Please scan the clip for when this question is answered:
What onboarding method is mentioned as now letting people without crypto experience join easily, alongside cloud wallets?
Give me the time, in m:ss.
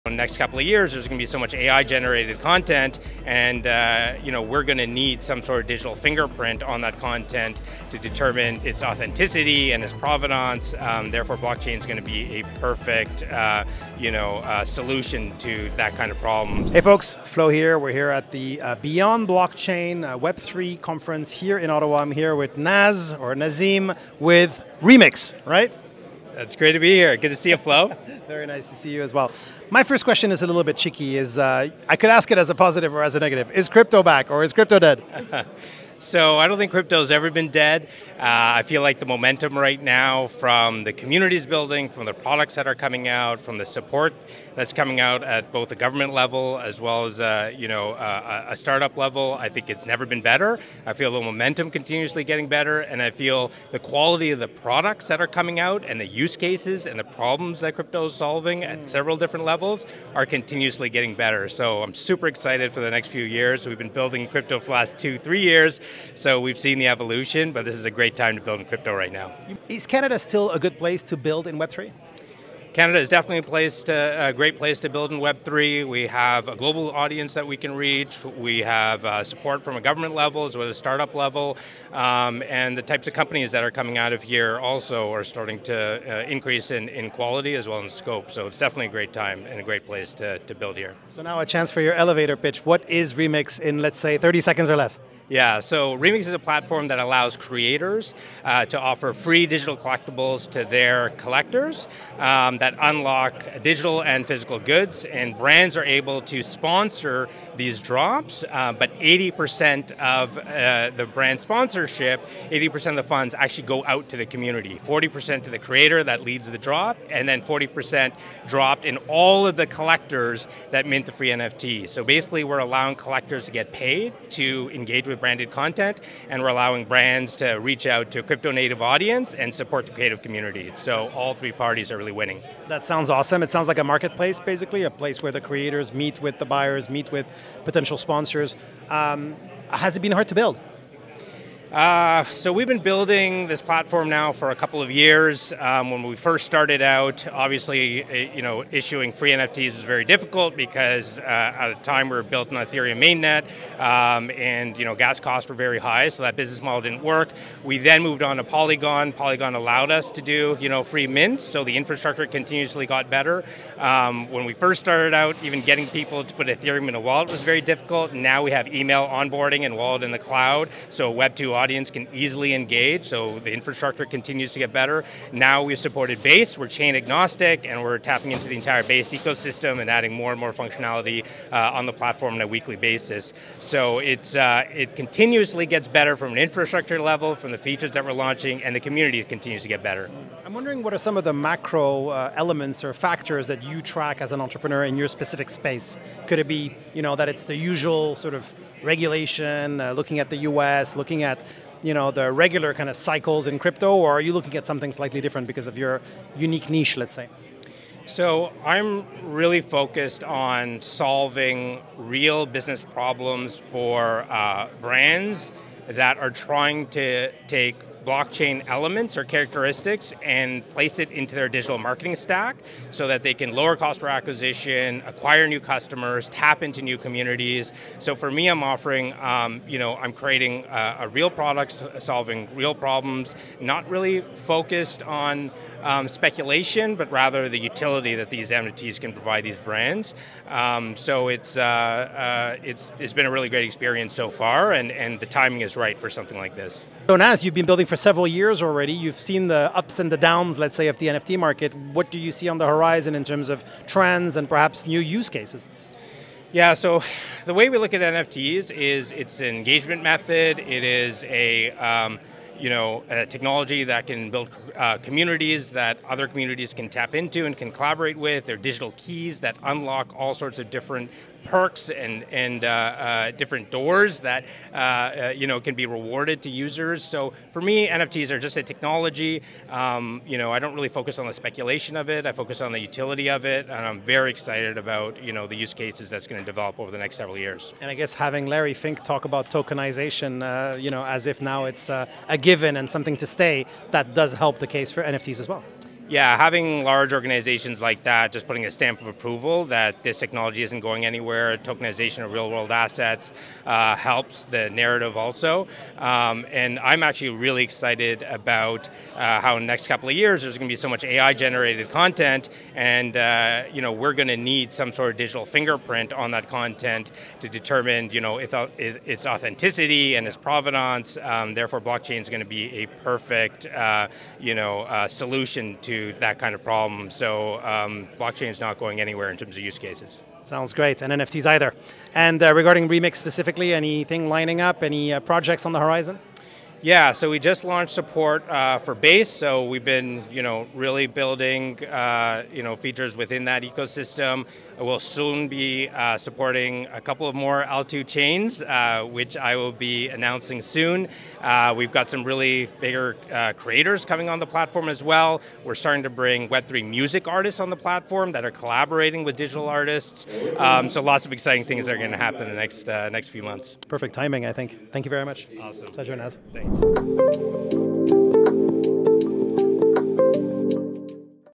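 2:48.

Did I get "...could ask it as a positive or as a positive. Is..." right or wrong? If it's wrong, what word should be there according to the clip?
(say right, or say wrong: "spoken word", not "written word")
wrong: "negative", not "positive".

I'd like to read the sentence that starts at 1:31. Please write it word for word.
So now a chance for your elevator pitch.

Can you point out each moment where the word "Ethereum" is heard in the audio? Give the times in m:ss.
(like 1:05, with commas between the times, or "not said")
2:32, 2:46.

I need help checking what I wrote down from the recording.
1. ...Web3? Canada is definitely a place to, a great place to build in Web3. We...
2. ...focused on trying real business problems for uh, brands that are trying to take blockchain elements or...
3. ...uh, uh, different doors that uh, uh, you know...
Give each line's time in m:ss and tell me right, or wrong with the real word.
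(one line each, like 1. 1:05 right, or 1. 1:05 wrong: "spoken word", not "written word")
1. 1:11 right
2. 3:29 wrong: "solving", not "trying"
3. 4:32 right.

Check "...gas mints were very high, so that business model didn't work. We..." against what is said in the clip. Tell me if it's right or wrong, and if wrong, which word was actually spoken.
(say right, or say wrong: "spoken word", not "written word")
wrong: "costs", not "mints".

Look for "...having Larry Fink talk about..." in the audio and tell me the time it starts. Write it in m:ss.
4:48.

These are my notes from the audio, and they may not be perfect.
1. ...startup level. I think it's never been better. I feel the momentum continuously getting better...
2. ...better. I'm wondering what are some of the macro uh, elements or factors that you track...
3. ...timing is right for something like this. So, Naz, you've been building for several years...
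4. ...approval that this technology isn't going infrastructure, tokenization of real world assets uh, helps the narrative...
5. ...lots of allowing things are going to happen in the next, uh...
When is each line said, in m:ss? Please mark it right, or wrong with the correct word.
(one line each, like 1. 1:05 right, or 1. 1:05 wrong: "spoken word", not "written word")
1. 0:48 right
2. 3:09 right
3. 4:05 right
4. 4:59 wrong: "anywhere", not "infrastructure"
5. 6:01 wrong: "exciting", not "allowing".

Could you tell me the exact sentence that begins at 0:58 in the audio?
several different levels are continuously getting better.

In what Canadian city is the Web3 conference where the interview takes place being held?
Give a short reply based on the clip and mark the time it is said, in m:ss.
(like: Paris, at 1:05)
Ottawa, at 0:21.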